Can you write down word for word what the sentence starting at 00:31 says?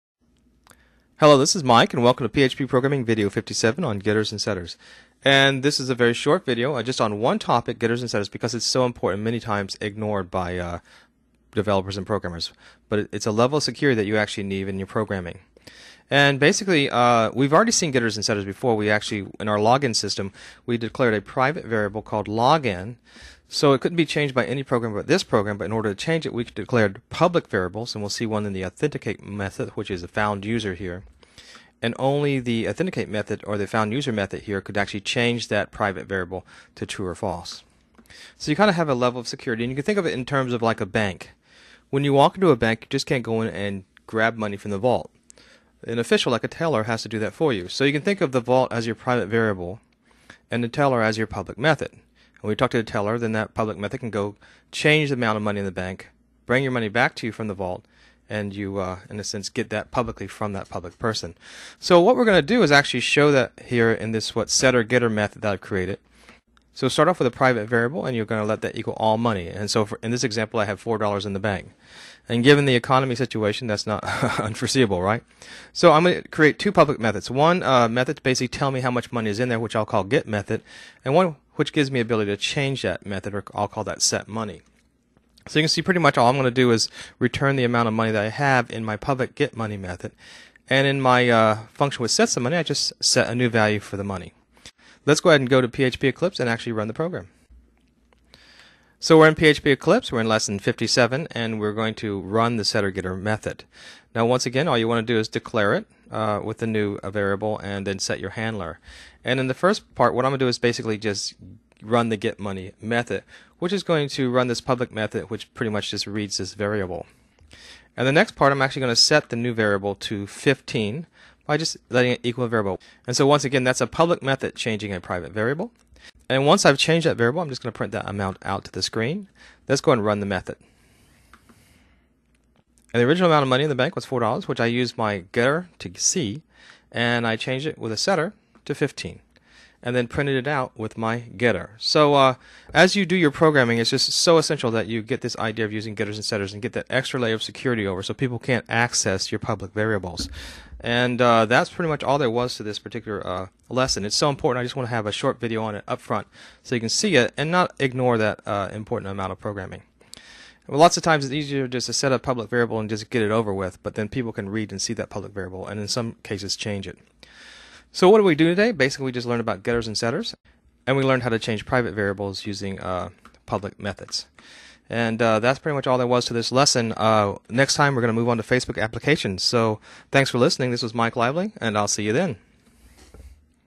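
And only the authenticate method or the found user method here could actually change that private variable to true or false.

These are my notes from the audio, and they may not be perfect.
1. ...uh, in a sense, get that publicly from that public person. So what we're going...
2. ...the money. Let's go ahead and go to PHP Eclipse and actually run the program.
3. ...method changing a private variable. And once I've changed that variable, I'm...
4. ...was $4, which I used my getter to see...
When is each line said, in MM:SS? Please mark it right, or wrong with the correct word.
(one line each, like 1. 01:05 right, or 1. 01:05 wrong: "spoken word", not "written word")
1. 00:58 right
2. 01:33 right
3. 02:04 right
4. 02:13 right.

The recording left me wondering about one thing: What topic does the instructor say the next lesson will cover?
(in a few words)
Facebook applications.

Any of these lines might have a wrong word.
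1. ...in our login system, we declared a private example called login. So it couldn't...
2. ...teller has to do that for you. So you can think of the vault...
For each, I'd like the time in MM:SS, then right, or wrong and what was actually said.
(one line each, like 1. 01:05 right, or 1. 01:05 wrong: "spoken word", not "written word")
1. 00:19 wrong: "variable", not "example"
2. 00:46 right.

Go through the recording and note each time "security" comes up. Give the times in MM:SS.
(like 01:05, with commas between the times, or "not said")
00:13, 00:39, 02:27.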